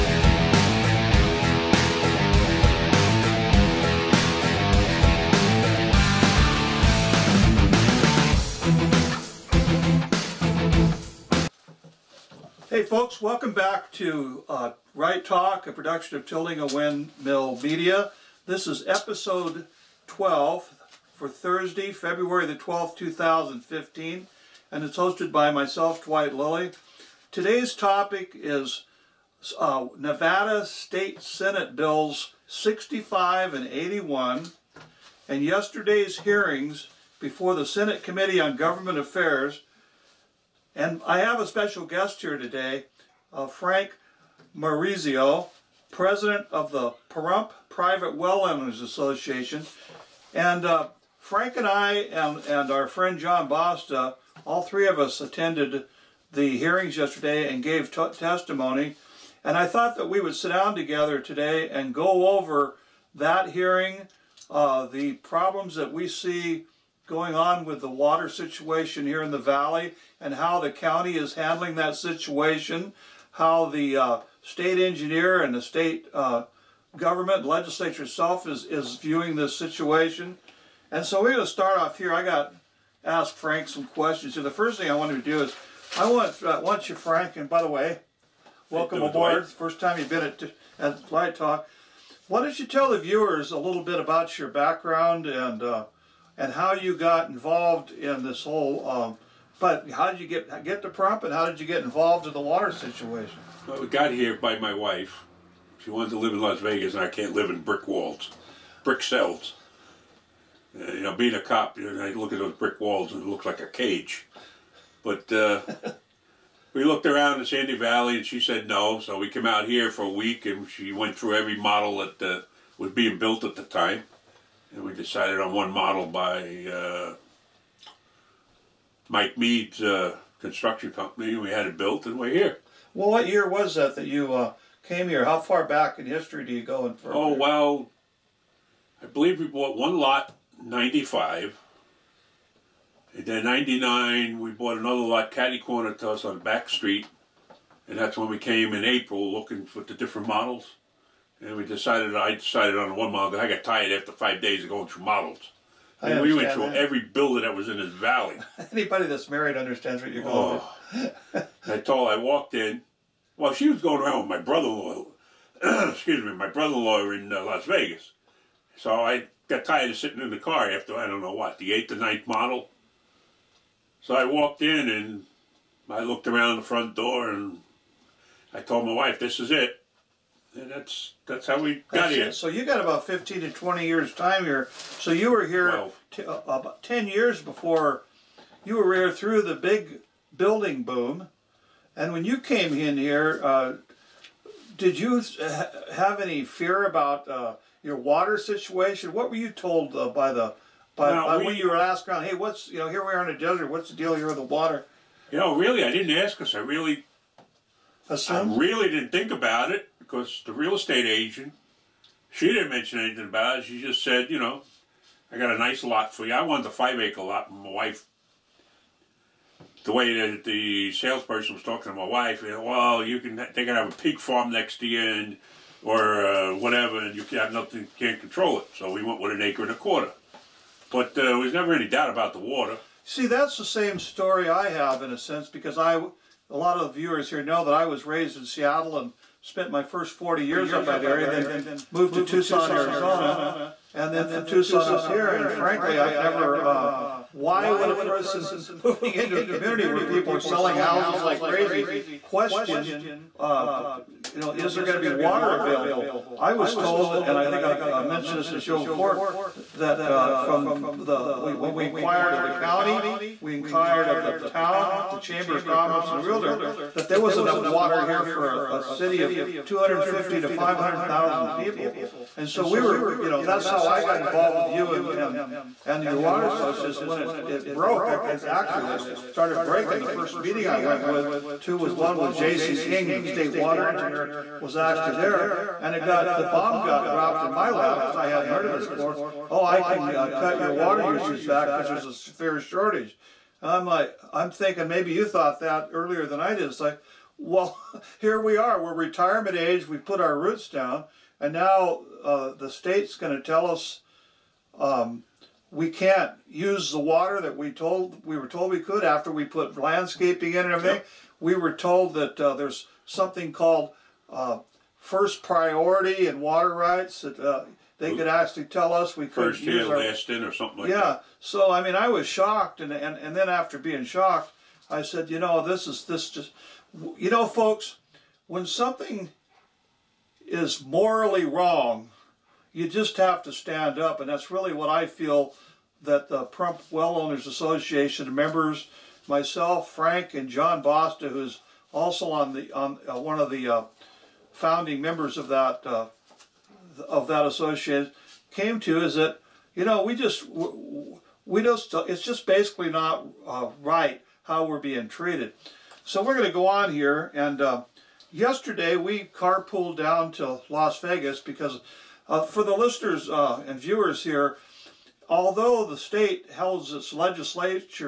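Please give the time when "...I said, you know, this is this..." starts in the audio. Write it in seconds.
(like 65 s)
324 s.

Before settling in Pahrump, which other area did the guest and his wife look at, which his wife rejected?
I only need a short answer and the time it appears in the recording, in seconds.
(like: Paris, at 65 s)
Sandy Valley, at 117 s.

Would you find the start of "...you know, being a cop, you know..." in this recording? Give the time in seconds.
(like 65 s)
110 s.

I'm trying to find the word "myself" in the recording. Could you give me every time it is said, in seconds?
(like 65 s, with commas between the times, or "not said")
25 s, 339 s.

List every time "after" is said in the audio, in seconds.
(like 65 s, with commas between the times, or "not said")
153 s, 170 s, 309 s, 323 s.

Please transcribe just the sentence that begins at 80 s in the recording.
And so we're going to start off here.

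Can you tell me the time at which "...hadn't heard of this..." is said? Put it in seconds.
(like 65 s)
288 s.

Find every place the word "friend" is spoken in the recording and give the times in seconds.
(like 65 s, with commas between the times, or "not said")
52 s.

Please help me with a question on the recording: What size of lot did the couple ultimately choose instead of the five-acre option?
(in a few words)
an acre and a quarter.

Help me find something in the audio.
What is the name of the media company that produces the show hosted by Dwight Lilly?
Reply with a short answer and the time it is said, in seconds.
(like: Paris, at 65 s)
Tilting a Windmill Media, at 16 s.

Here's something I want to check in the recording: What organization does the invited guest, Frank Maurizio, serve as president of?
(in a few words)
Pahrump Private Well Owners Association.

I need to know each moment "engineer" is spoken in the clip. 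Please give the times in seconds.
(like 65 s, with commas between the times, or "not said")
74 s, 283 s.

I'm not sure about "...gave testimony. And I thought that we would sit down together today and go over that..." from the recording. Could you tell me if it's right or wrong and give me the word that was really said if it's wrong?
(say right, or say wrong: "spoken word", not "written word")
right.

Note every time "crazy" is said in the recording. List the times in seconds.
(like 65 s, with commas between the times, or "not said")
251 s.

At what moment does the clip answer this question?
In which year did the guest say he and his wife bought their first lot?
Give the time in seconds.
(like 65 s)
140 s.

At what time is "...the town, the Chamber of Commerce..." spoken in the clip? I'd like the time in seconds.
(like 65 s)
264 s.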